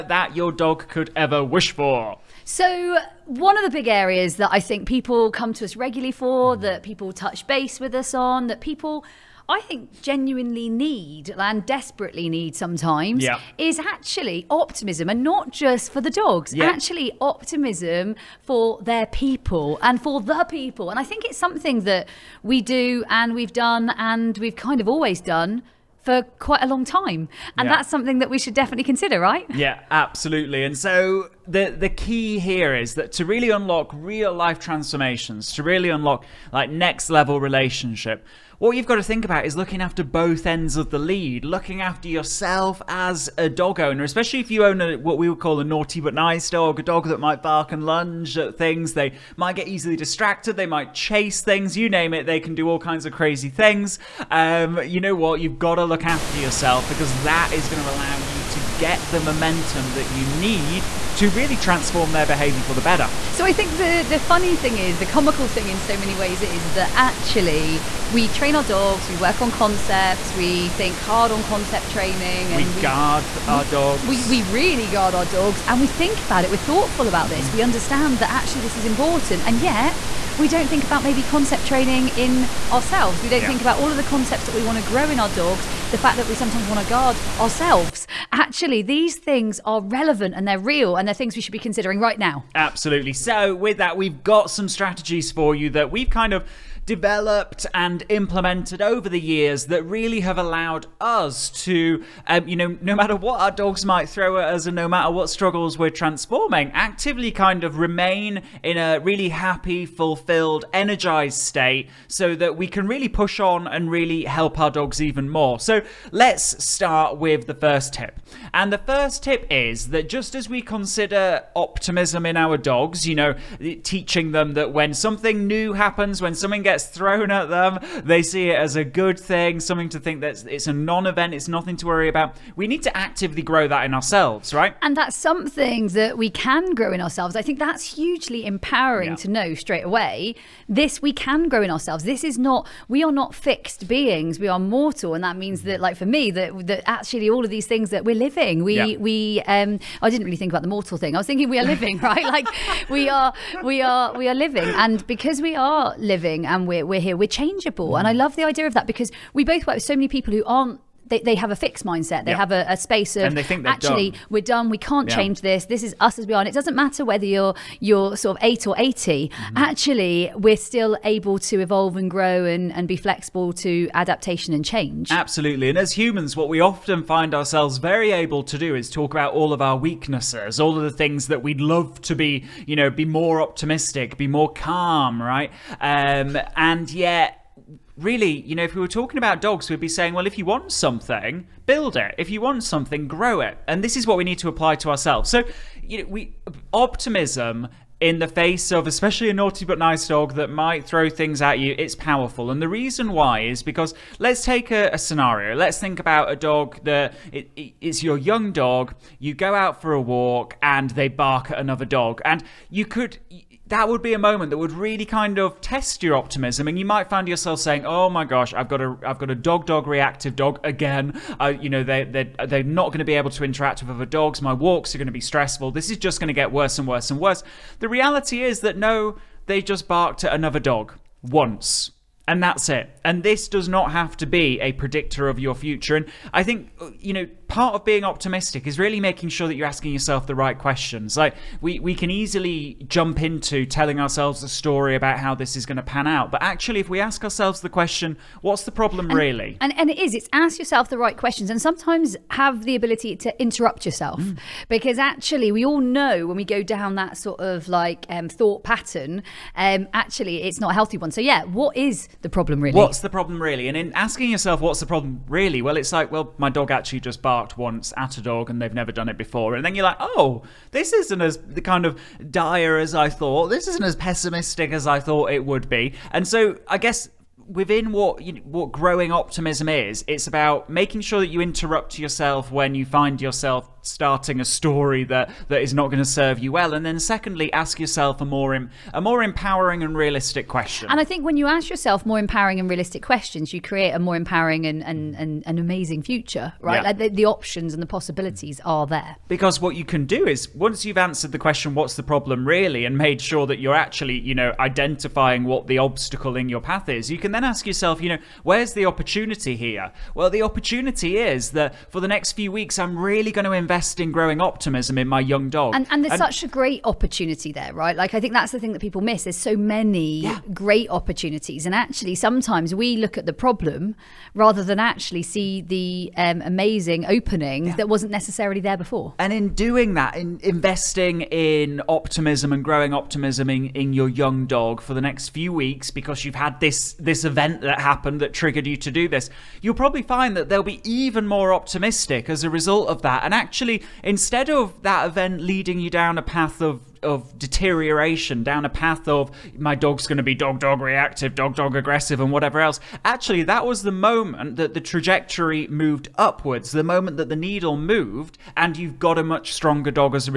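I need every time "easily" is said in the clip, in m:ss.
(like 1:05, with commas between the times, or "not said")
0:49, 4:02.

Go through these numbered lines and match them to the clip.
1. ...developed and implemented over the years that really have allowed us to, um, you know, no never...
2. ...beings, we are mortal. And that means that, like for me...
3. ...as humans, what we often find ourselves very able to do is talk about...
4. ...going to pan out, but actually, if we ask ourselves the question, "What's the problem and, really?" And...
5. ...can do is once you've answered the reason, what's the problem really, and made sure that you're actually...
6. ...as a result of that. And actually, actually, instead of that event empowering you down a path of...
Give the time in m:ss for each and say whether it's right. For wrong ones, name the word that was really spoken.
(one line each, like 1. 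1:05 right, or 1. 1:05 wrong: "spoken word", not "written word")
1. 1:36 wrong: "matter", not "never"
2. 2:23 right
3. 2:55 right
4. 4:05 right
5. 4:59 wrong: "question", not "reason"
6. 5:42 wrong: "leading", not "empowering".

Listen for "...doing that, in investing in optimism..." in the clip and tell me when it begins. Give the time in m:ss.
5:29.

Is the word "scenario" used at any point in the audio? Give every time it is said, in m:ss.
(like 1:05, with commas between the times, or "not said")
3:24.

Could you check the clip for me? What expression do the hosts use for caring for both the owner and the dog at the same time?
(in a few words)
both ends of the lead.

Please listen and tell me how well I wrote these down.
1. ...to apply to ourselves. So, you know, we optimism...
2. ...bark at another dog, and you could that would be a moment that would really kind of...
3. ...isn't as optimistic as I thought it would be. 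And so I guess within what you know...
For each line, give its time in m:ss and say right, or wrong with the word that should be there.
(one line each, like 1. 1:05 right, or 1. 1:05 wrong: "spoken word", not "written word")
1. 3:14 right
2. 3:31 right
3. 4:33 wrong: "pessimistic", not "optimistic".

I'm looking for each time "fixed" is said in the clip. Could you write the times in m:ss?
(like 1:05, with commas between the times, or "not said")
2:23, 2:41.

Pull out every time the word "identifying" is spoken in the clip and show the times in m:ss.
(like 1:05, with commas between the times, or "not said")
5:04.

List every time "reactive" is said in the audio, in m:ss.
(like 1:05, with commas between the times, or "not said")
3:39, 5:50.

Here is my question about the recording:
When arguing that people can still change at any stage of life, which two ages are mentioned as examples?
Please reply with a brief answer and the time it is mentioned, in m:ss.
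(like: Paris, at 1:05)
8 or 80, at 2:48.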